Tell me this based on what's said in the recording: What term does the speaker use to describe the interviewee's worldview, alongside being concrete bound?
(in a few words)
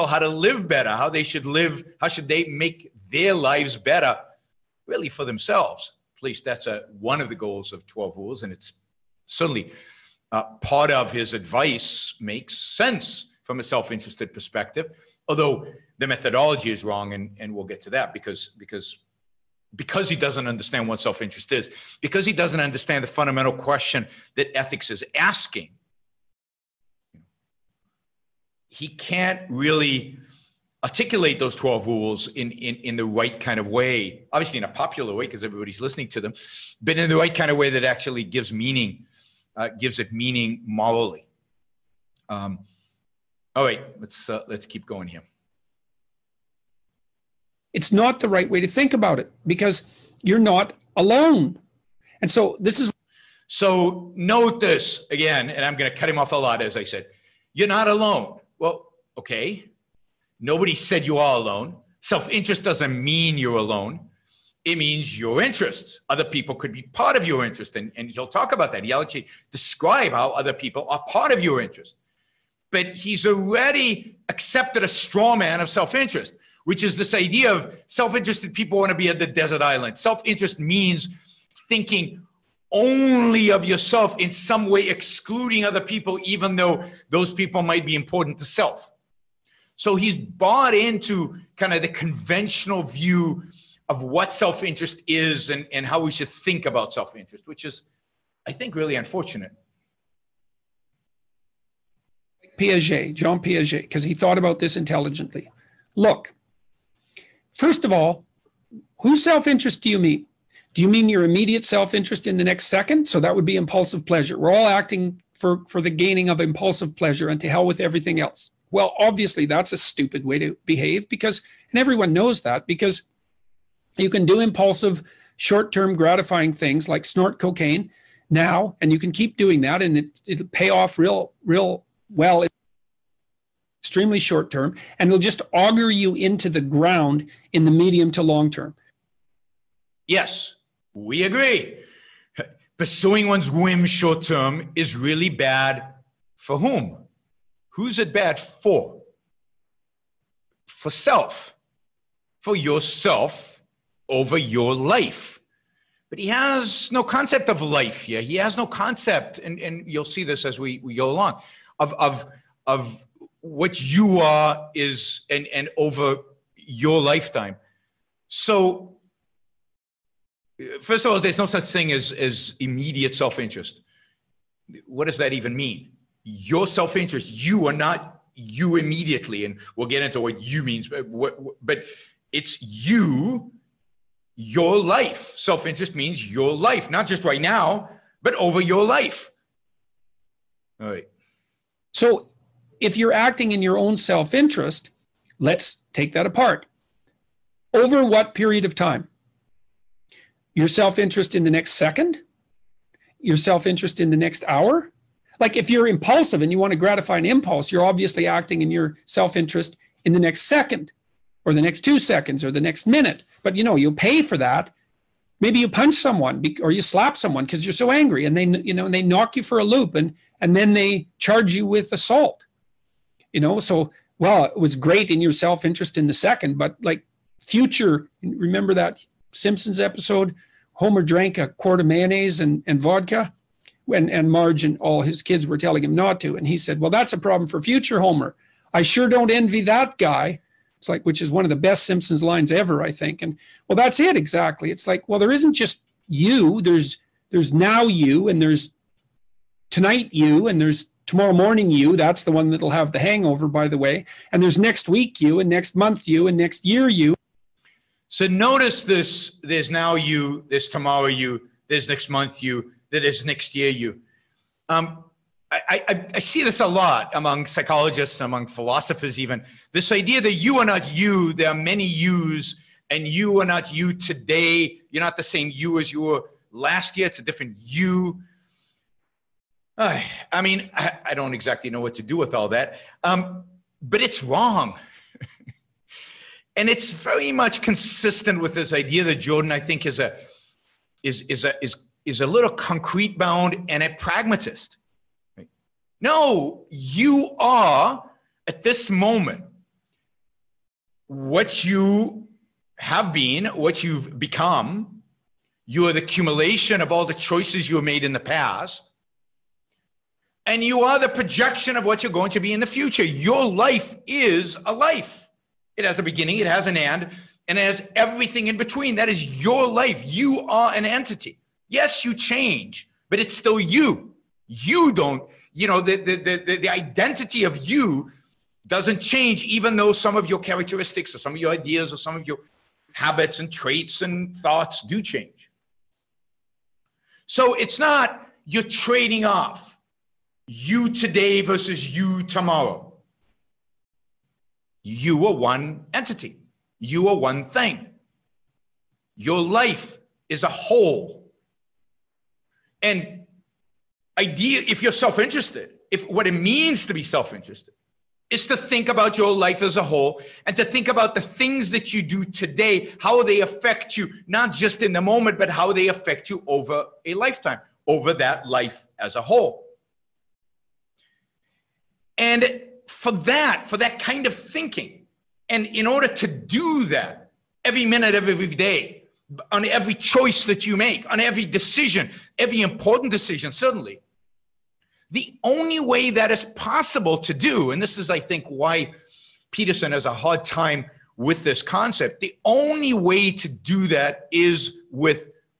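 pragmatist.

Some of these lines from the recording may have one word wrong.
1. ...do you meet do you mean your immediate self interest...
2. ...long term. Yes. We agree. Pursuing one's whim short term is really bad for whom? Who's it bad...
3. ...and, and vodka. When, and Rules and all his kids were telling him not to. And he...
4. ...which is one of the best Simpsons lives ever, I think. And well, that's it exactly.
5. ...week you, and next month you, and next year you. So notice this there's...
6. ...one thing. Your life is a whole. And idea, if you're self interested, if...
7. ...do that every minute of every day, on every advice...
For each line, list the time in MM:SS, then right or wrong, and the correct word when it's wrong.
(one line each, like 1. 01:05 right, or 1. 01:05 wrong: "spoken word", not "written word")
1. 01:49 right
2. 02:18 right
3. 03:52 wrong: "Marge", not "Rules"
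4. 04:01 wrong: "lines", not "lives"
5. 04:14 right
6. 05:47 right
7. 06:16 wrong: "choice", not "advice".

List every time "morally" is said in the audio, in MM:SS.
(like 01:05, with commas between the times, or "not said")
00:40.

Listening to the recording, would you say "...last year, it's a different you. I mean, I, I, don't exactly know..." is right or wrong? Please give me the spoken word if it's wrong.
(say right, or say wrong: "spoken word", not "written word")
right.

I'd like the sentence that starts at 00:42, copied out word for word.
Um, all right, let's, uh, let's keep going here.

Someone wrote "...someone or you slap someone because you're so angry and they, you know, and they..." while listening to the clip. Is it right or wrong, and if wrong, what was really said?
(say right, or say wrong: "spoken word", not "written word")
right.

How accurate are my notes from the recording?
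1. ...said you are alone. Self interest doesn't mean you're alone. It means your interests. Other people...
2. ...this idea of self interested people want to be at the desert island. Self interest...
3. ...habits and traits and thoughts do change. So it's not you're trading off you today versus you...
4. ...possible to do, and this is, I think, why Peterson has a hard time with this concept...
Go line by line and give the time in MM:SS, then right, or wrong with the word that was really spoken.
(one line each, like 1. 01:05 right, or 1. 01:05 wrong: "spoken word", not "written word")
1. 01:00 right
2. 01:16 right
3. 05:32 right
4. 06:26 right.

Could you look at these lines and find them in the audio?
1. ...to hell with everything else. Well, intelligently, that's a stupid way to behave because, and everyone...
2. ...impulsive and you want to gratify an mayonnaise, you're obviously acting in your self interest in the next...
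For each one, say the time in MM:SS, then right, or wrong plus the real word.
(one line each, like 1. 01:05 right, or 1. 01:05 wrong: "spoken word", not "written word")
1. 01:57 wrong: "obviously", not "intelligently"
2. 03:25 wrong: "impulse", not "mayonnaise".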